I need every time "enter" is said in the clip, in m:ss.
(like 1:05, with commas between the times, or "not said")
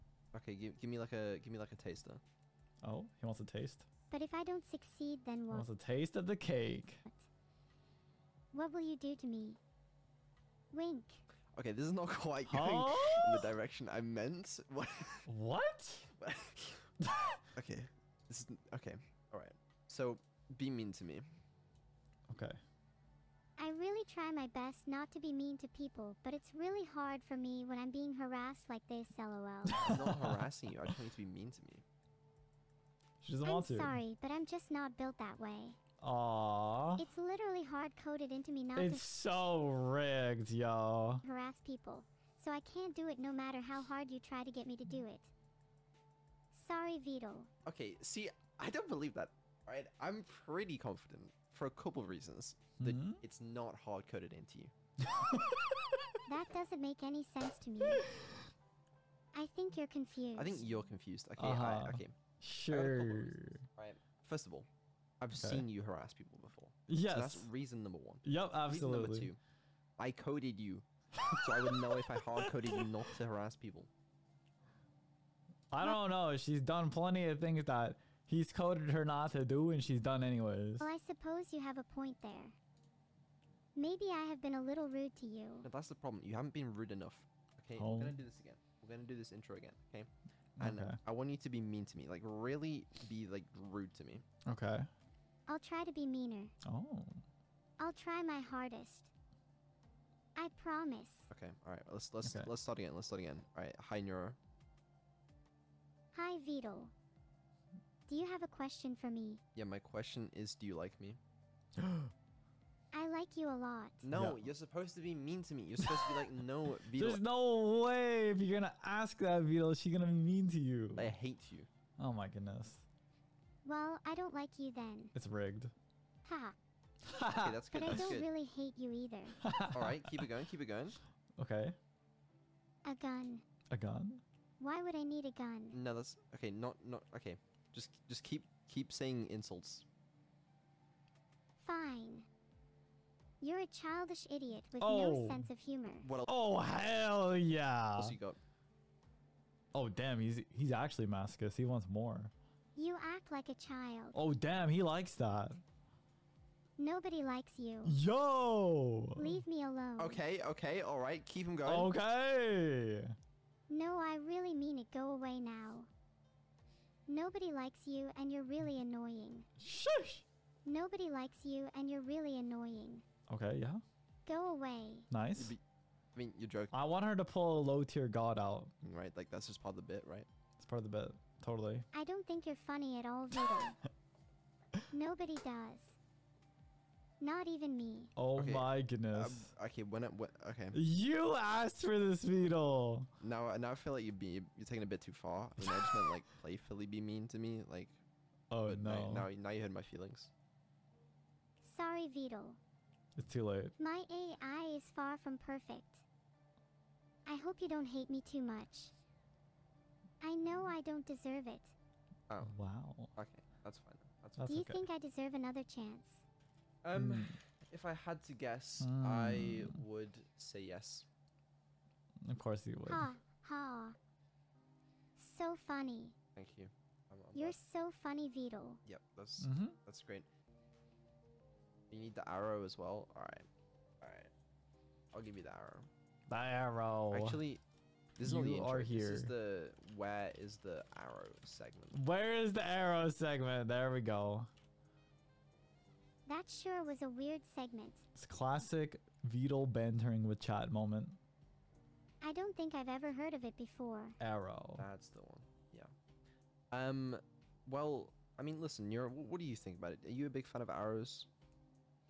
not said.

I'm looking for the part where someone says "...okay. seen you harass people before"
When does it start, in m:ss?
1:05.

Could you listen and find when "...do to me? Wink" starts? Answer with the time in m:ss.
0:08.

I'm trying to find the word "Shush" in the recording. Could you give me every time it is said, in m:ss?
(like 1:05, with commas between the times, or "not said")
2:49.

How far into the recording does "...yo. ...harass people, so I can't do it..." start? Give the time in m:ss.
0:40.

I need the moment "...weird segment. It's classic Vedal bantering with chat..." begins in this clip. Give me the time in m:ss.
4:07.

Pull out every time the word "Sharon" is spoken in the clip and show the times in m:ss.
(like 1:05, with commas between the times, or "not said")
not said.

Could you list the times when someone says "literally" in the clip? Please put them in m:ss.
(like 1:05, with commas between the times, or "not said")
0:37.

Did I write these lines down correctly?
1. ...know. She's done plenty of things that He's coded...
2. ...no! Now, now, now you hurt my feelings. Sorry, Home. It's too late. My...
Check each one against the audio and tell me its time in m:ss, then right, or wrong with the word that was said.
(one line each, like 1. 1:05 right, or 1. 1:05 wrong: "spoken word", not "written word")
1. 1:16 right
2. 3:18 wrong: "Vedal", not "Home".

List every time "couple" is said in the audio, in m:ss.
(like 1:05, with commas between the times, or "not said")
0:51.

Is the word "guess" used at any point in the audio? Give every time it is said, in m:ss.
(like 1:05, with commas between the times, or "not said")
3:38.